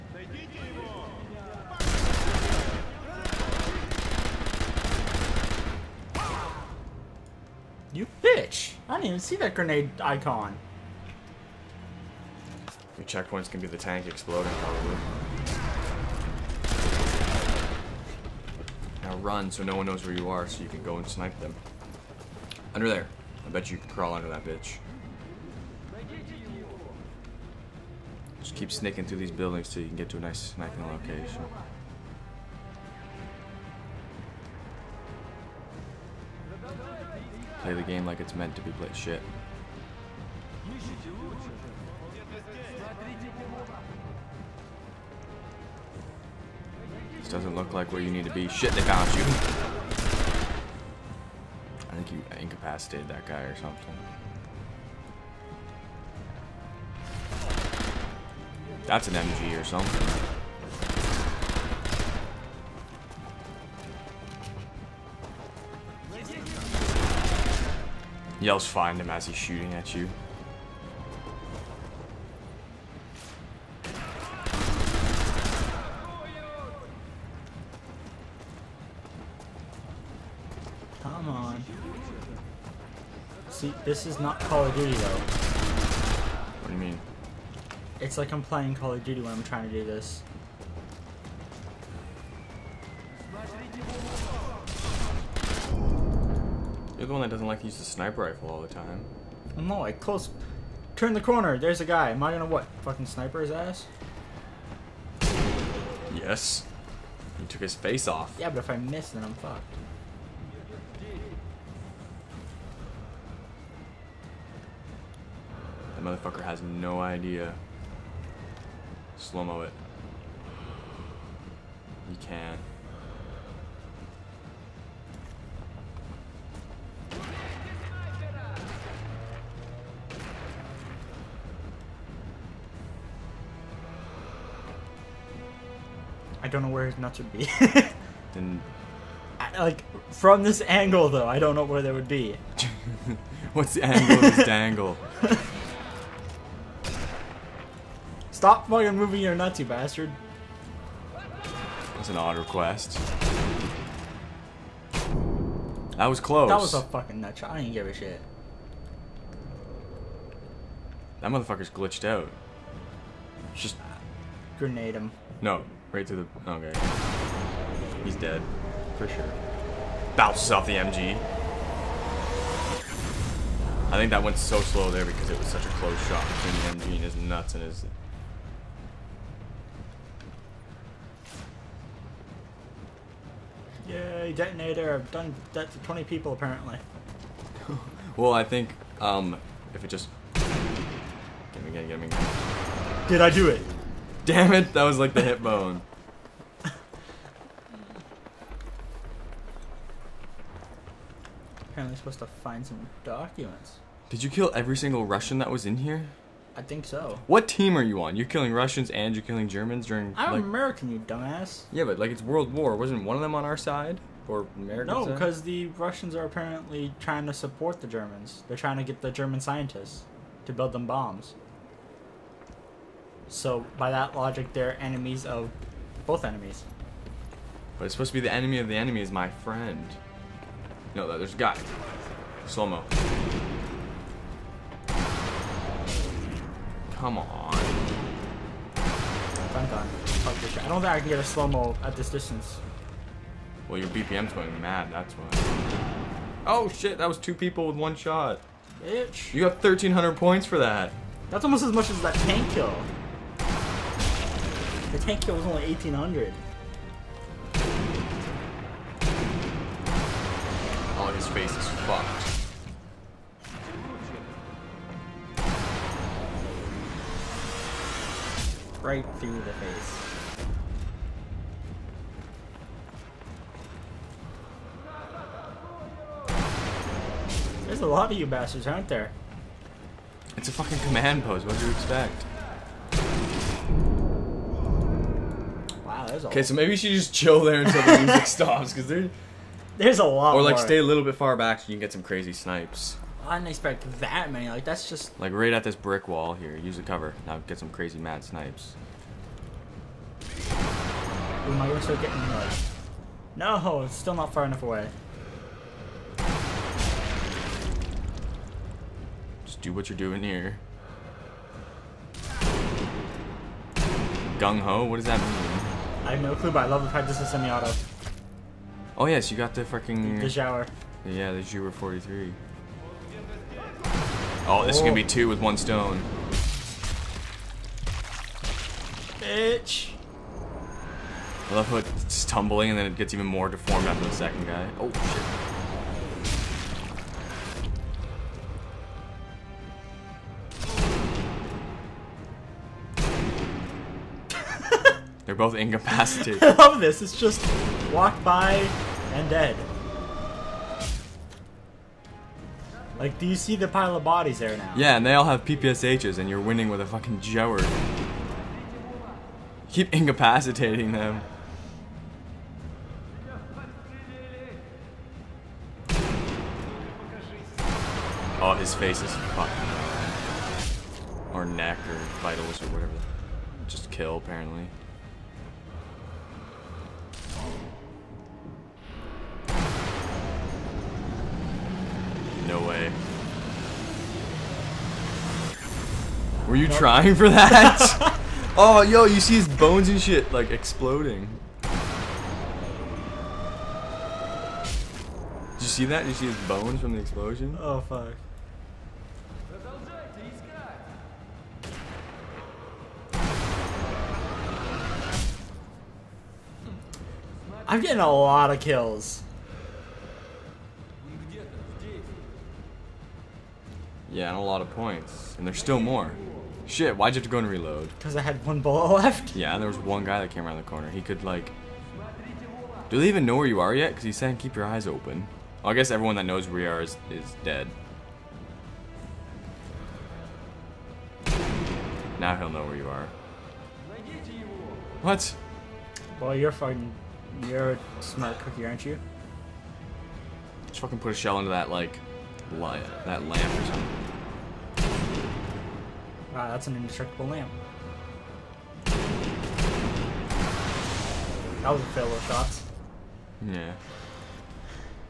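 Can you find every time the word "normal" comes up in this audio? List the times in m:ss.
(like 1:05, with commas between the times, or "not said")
not said.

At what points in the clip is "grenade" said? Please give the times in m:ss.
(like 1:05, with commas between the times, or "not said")
0:09, 2:44.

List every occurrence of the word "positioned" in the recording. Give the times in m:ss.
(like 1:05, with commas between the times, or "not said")
not said.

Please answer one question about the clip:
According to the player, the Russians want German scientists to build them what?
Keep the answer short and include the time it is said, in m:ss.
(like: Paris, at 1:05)
bombs, at 3:40.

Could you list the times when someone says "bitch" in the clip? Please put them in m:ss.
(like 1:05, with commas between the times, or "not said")
0:08, 0:24, 4:08, 5:29.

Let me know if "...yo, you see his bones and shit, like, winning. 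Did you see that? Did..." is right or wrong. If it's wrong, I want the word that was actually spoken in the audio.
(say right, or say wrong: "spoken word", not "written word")
wrong: "exploding", not "winning".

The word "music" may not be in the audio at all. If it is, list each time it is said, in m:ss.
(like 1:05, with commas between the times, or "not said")
4:48.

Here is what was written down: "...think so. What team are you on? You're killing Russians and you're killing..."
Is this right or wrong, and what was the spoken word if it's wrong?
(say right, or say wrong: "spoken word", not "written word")
right.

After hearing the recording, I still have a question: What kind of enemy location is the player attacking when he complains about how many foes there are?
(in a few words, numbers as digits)
command post.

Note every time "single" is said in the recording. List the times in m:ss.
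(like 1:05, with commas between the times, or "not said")
3:24.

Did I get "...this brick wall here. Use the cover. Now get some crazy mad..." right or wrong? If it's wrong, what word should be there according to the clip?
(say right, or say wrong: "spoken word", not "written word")
right.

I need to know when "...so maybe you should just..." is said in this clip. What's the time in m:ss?
4:46.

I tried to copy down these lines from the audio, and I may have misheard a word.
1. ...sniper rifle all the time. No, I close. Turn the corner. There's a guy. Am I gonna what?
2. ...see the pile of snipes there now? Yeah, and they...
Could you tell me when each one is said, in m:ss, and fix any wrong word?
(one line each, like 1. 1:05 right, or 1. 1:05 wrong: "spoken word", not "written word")
1. 1:37 right
2. 5:53 wrong: "bodies", not "snipes".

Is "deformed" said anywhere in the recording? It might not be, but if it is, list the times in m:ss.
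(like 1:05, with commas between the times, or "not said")
5:33.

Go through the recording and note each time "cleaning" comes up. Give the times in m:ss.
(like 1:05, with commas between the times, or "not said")
not said.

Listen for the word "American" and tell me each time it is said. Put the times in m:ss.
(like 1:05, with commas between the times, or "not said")
3:30, 3:34.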